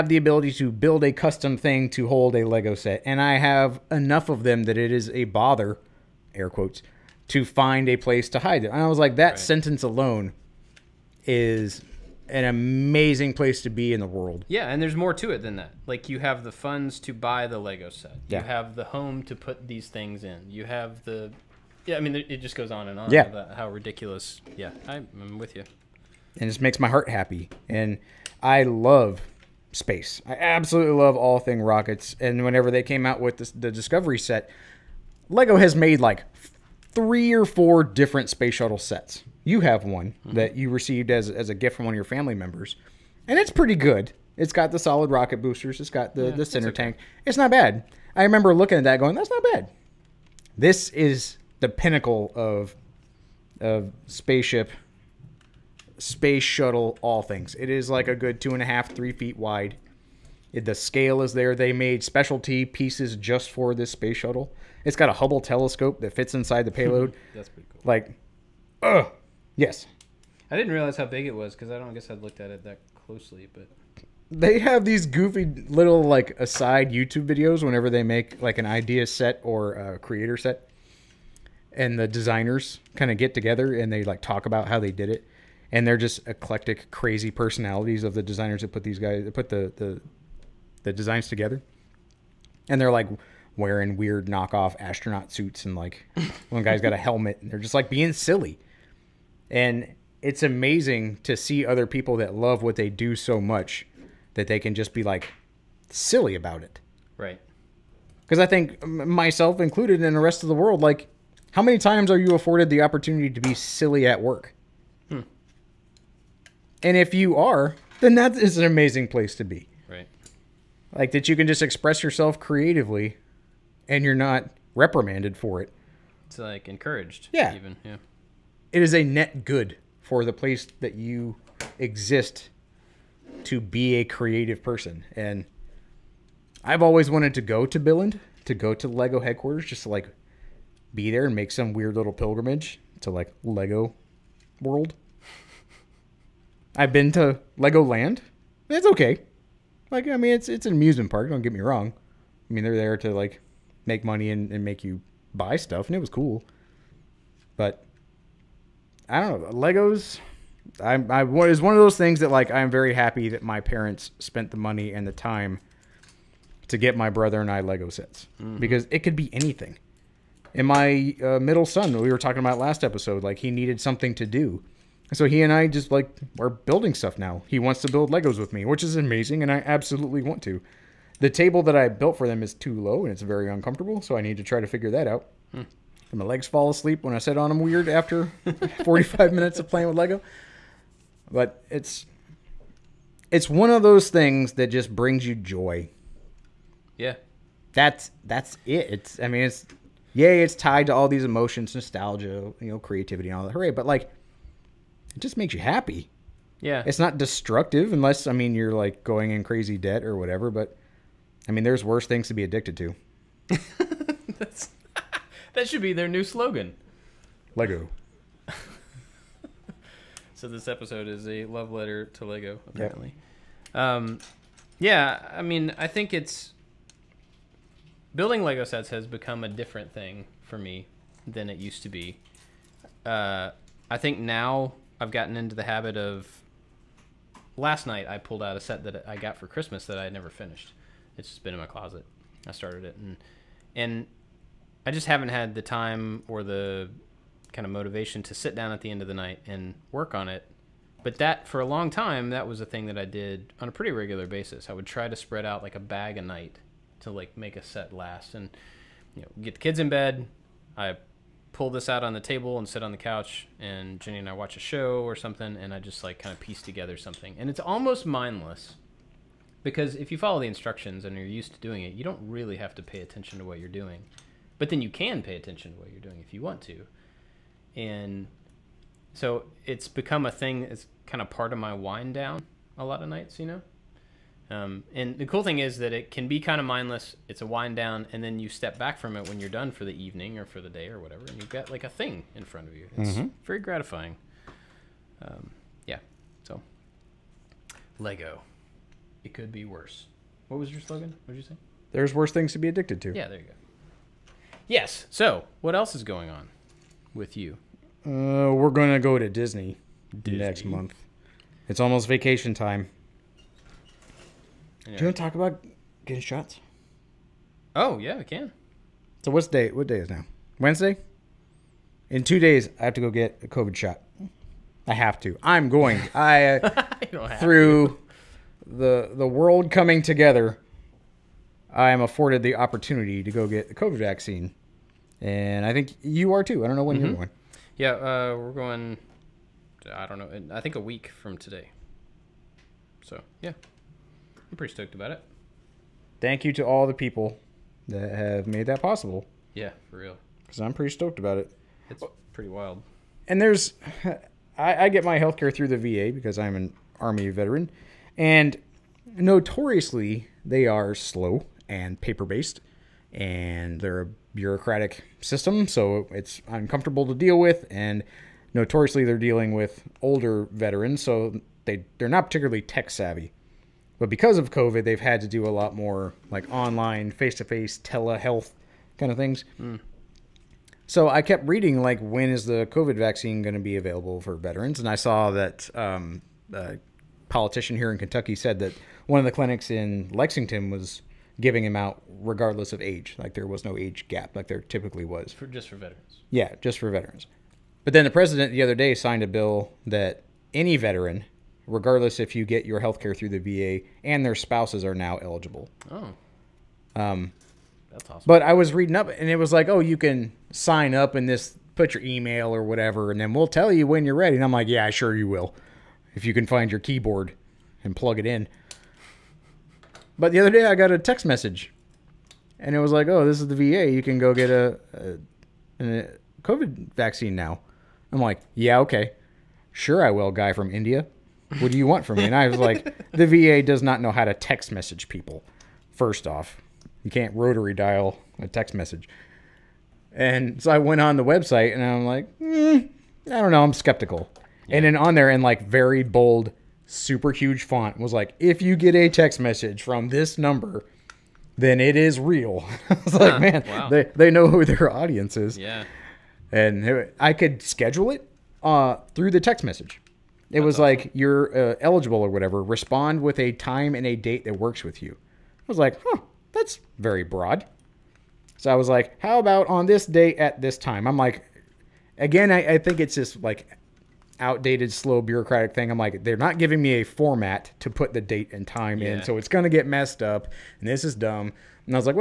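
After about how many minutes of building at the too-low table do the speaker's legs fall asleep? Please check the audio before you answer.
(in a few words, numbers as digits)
45 minutes.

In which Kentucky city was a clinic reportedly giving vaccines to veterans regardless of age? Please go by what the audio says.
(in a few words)
Lexington.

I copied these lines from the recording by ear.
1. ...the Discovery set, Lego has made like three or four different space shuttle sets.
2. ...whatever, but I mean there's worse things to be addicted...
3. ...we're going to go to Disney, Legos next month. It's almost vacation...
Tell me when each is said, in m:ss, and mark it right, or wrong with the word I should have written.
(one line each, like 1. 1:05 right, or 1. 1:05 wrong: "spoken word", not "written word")
1. 0:33 right
2. 3:30 right
3. 5:08 wrong: "Disney", not "Legos".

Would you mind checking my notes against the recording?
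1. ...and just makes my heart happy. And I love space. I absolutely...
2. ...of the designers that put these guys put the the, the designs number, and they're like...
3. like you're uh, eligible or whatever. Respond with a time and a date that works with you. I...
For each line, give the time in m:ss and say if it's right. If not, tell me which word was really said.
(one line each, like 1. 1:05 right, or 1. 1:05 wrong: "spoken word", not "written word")
1. 0:26 right
2. 1:28 wrong: "together", not "number"
3. 7:40 right.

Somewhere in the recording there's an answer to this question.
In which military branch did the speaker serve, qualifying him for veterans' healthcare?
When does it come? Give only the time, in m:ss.
5:57.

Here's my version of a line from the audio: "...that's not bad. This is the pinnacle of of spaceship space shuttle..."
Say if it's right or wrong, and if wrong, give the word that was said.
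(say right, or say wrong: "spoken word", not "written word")
right.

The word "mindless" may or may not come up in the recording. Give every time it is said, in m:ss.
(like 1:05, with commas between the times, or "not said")
4:28, 4:46.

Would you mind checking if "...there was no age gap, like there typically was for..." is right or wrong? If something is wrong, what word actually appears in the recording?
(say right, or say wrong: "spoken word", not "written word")
right.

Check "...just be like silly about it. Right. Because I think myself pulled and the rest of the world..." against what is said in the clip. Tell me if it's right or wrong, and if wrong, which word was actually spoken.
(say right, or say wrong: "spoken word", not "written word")
wrong: "included", not "pulled".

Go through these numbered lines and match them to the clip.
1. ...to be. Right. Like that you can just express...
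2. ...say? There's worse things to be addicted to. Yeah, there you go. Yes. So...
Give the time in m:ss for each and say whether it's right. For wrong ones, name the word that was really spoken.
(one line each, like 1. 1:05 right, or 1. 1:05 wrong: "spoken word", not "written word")
1. 1:59 right
2. 5:01 right.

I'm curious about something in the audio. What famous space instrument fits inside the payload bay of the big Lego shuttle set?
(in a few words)
Hubble telescope.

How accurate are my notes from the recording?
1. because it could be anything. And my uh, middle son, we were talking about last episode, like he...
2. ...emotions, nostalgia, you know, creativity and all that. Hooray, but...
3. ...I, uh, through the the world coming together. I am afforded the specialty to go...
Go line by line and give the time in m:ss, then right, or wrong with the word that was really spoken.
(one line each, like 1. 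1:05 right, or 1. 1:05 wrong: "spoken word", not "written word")
1. 2:48 right
2. 3:21 right
3. 5:26 wrong: "opportunity", not "specialty".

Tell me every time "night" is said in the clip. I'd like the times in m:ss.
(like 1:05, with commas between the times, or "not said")
3:57, 4:09, 4:16, 4:43.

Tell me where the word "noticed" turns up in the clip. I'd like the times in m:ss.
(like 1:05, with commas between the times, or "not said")
not said.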